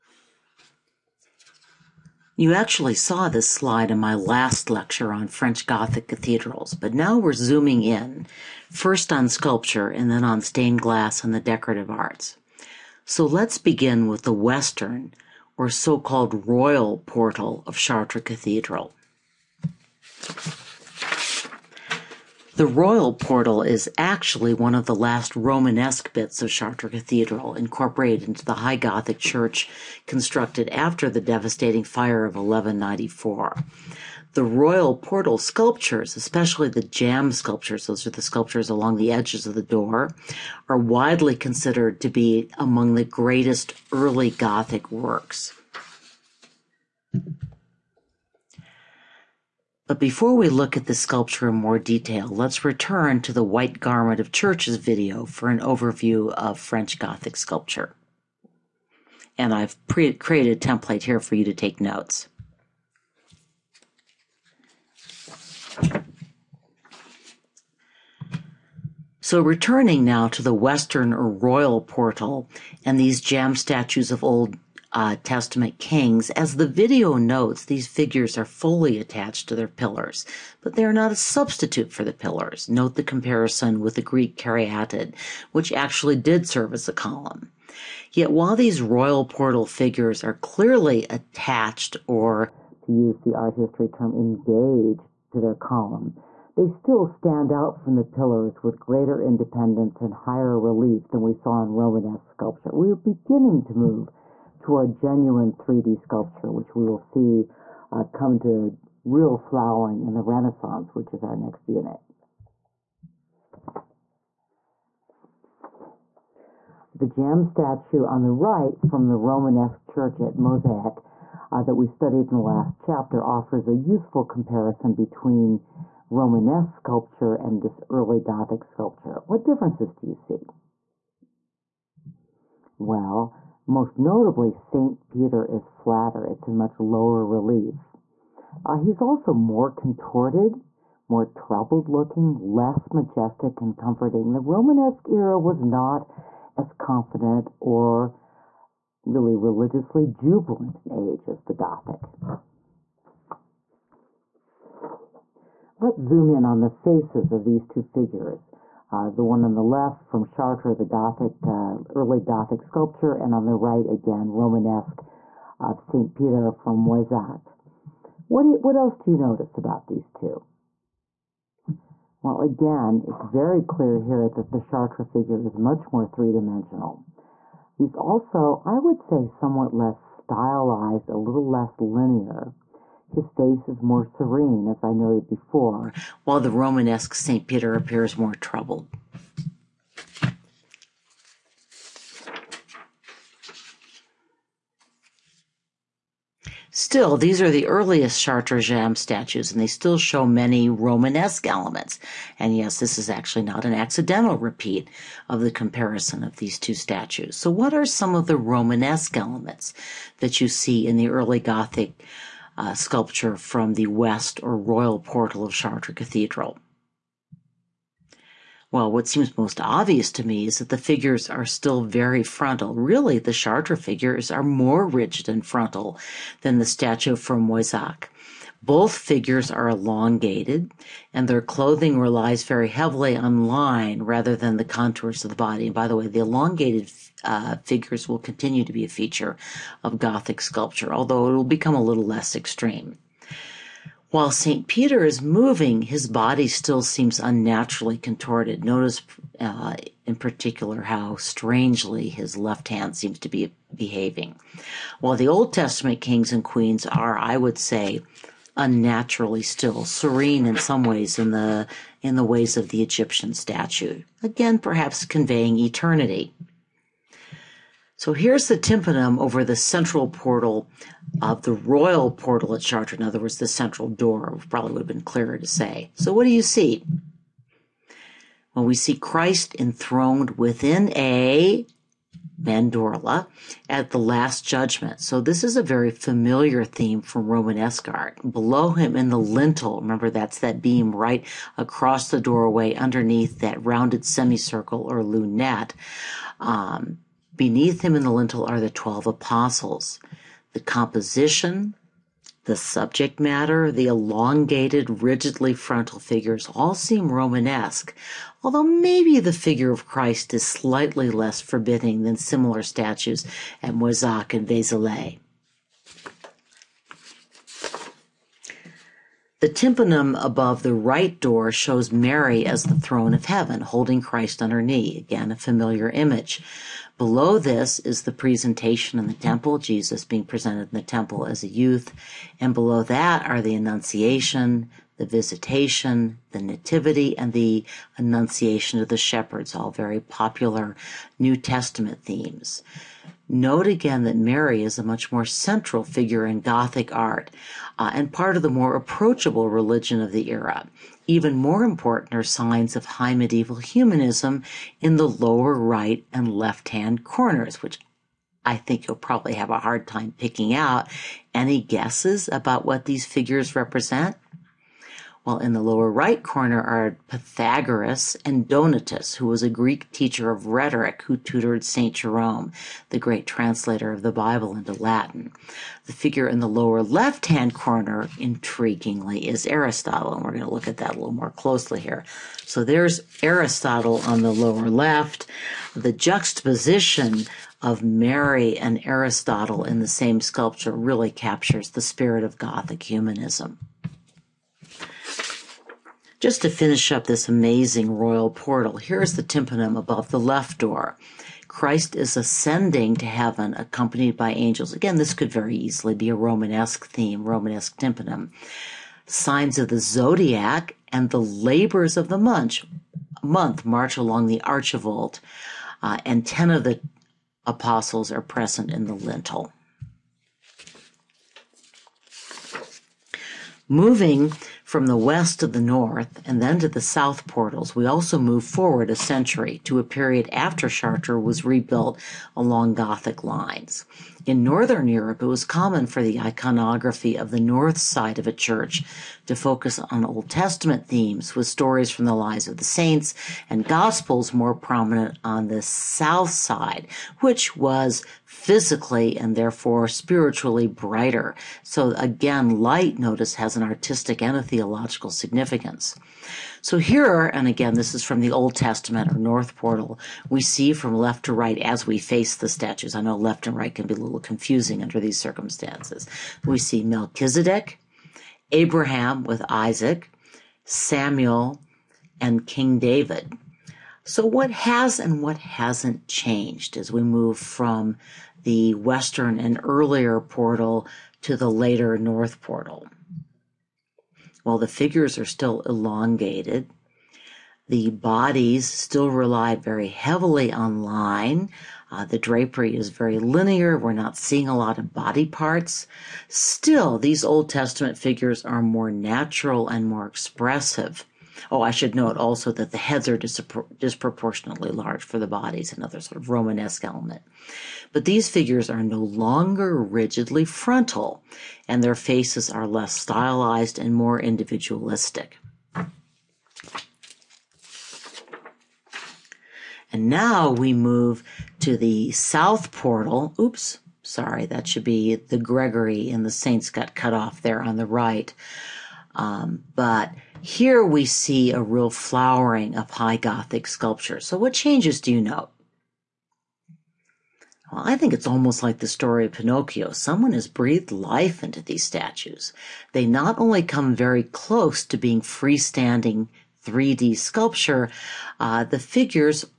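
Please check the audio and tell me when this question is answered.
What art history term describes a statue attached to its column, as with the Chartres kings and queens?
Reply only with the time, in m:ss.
1:34.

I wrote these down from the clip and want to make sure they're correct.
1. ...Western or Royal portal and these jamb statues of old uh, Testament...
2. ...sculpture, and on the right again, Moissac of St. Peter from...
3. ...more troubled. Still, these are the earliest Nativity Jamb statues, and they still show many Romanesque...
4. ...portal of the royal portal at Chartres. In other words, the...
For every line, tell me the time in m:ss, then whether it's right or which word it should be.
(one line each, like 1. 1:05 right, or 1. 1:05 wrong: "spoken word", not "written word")
1. 1:10 right
2. 2:42 wrong: "Romanesque", not "Moissac"
3. 3:08 wrong: "Chartres", not "Nativity"
4. 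4:30 right.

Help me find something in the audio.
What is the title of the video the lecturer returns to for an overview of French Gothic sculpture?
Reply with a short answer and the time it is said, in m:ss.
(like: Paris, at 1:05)
White Garment of Churches, at 0:53.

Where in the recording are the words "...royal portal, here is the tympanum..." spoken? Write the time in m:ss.
6:37.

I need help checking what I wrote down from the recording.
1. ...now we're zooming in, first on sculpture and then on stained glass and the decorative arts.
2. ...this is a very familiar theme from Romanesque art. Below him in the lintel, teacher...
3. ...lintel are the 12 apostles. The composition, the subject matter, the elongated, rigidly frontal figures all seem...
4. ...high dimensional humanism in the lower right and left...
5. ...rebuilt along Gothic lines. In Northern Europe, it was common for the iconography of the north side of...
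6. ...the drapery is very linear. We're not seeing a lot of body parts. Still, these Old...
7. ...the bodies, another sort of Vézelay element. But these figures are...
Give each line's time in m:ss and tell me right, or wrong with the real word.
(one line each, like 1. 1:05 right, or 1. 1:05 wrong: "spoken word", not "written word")
1. 0:06 right
2. 4:45 wrong: "remember", not "teacher"
3. 4:58 right
4. 5:52 wrong: "medieval", not "dimensional"
5. 7:11 right
6. 8:12 right
7. 8:25 wrong: "Romanesque", not "Vézelay".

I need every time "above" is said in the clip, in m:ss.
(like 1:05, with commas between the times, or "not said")
5:20, 6:39.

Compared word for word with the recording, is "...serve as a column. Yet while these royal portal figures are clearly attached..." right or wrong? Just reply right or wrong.
right.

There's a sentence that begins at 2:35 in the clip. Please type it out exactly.
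Let's zoom in on the faces of these two figures.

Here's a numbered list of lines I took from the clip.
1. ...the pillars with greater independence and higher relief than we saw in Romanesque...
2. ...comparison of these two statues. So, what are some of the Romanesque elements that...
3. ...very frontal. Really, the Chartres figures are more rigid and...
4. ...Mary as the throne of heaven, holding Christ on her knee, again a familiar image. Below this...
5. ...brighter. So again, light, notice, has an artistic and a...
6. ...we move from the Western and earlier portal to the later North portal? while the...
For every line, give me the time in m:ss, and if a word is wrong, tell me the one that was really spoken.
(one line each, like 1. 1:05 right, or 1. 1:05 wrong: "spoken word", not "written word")
1. 1:37 right
2. 3:25 right
3. 3:41 right
4. 5:21 right
5. 7:30 right
6. 7:56 right.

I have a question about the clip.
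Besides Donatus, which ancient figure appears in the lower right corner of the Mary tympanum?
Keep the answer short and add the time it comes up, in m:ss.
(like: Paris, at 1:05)
Pythagoras, at 6:07.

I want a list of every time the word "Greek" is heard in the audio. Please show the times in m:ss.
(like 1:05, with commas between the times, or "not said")
1:24, 6:09.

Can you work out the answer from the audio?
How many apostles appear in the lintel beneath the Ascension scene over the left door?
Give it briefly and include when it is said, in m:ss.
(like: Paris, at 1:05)
10, at 6:56.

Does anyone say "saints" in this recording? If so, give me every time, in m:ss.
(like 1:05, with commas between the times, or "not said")
7:22, 8:46.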